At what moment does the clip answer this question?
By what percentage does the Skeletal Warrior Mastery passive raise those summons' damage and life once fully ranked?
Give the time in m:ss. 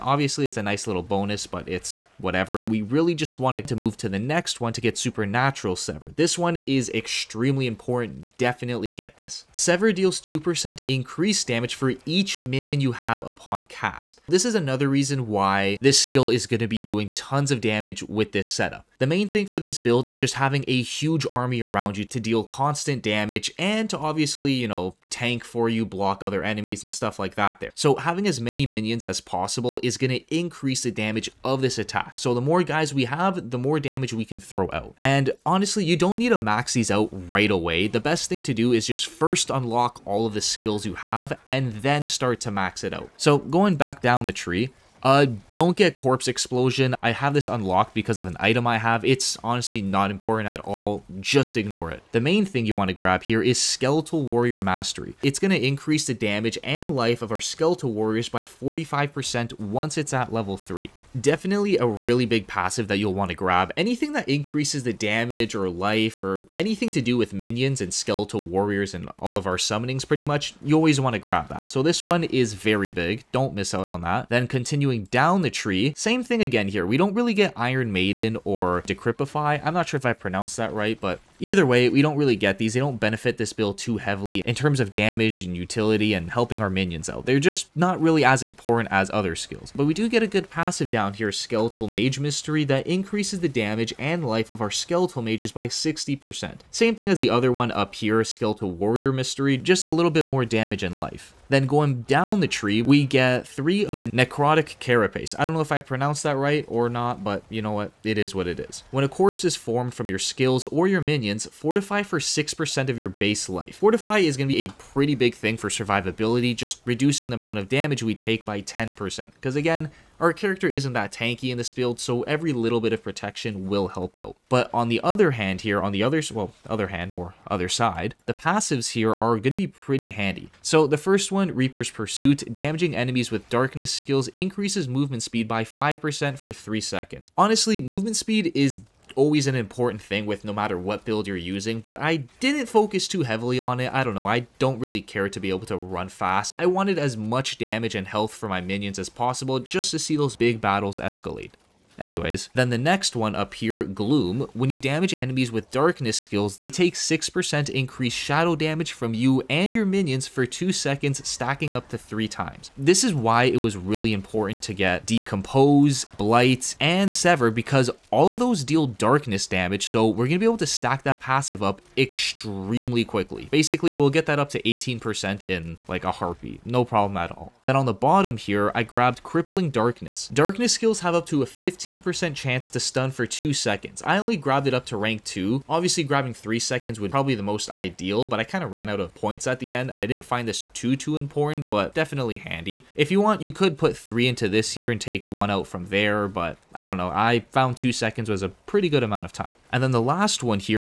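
0:58.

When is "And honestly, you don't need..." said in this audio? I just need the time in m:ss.
0:34.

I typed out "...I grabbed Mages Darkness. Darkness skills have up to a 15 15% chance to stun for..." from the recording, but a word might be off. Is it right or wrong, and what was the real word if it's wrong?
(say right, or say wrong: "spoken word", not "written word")
wrong: "Crippling", not "Mages".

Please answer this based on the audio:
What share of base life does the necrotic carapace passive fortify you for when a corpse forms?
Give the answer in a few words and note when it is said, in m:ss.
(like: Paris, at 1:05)
6%, at 1:52.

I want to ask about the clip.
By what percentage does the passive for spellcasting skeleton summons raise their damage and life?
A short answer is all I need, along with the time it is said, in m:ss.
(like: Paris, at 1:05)
60%, at 1:35.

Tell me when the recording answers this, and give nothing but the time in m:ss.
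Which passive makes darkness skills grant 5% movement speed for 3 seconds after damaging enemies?
2:11.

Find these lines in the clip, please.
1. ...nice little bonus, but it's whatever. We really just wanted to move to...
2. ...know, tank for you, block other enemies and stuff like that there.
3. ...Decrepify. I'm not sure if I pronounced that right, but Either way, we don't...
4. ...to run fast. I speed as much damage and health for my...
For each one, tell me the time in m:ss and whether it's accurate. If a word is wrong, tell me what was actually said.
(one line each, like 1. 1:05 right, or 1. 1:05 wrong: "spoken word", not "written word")
1. 0:00 right
2. 0:24 right
3. 1:18 right
4. 2:25 wrong: "wanted", not "speed".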